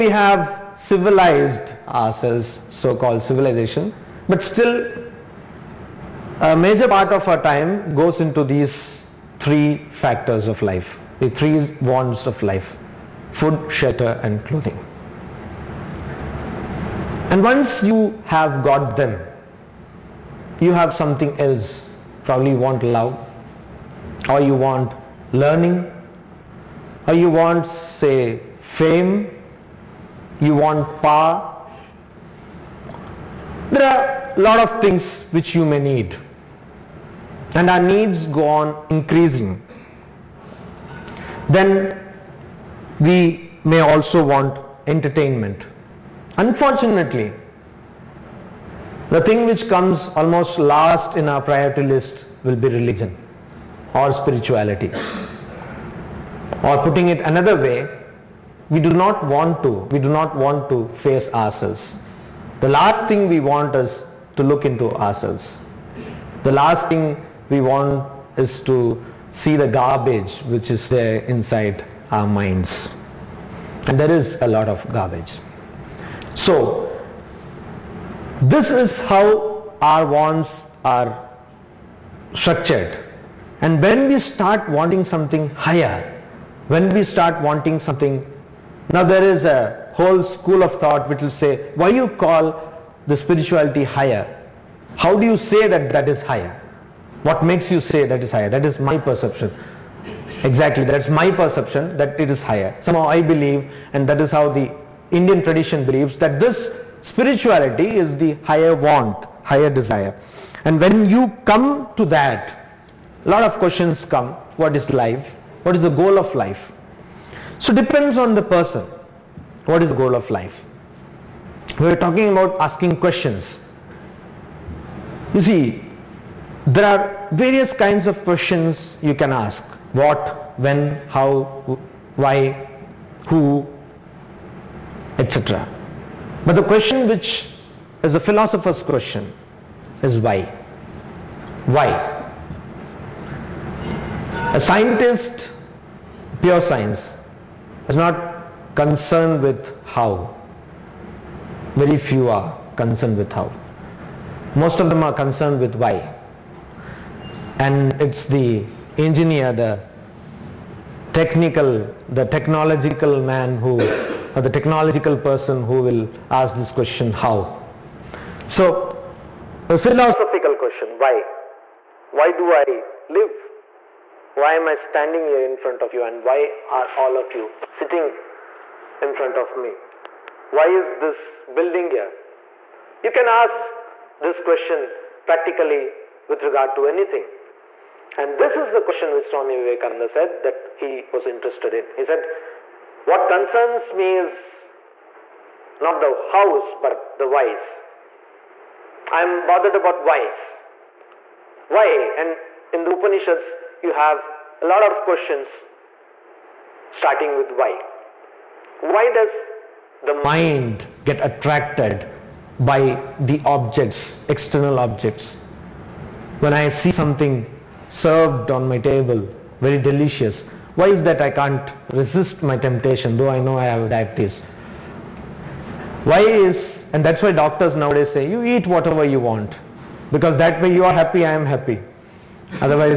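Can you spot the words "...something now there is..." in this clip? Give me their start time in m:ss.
1:27.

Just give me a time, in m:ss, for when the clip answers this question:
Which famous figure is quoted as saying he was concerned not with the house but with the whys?
3:09.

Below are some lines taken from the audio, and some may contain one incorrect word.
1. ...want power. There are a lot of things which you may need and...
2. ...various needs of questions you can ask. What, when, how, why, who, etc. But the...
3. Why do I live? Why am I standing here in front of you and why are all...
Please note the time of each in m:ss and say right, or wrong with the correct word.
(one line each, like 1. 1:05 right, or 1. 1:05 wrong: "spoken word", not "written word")
1. 0:30 right
2. 2:07 wrong: "kinds", not "needs"
3. 2:52 right.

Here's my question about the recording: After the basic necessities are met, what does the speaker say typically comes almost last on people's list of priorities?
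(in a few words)
religion or spirituality.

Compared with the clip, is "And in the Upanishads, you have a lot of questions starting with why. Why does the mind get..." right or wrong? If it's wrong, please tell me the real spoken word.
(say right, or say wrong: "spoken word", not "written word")
right.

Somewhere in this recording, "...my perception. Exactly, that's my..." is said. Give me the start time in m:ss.
1:38.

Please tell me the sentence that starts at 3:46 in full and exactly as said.
Why is, and that's why doctors nowadays say, you eat whatever you want because that way you are happy, I am happy.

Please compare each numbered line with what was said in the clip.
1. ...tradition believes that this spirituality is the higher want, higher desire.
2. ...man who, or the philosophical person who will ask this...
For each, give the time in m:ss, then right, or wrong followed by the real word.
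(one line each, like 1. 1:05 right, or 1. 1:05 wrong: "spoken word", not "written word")
1. 1:45 right
2. 2:43 wrong: "technological", not "philosophical".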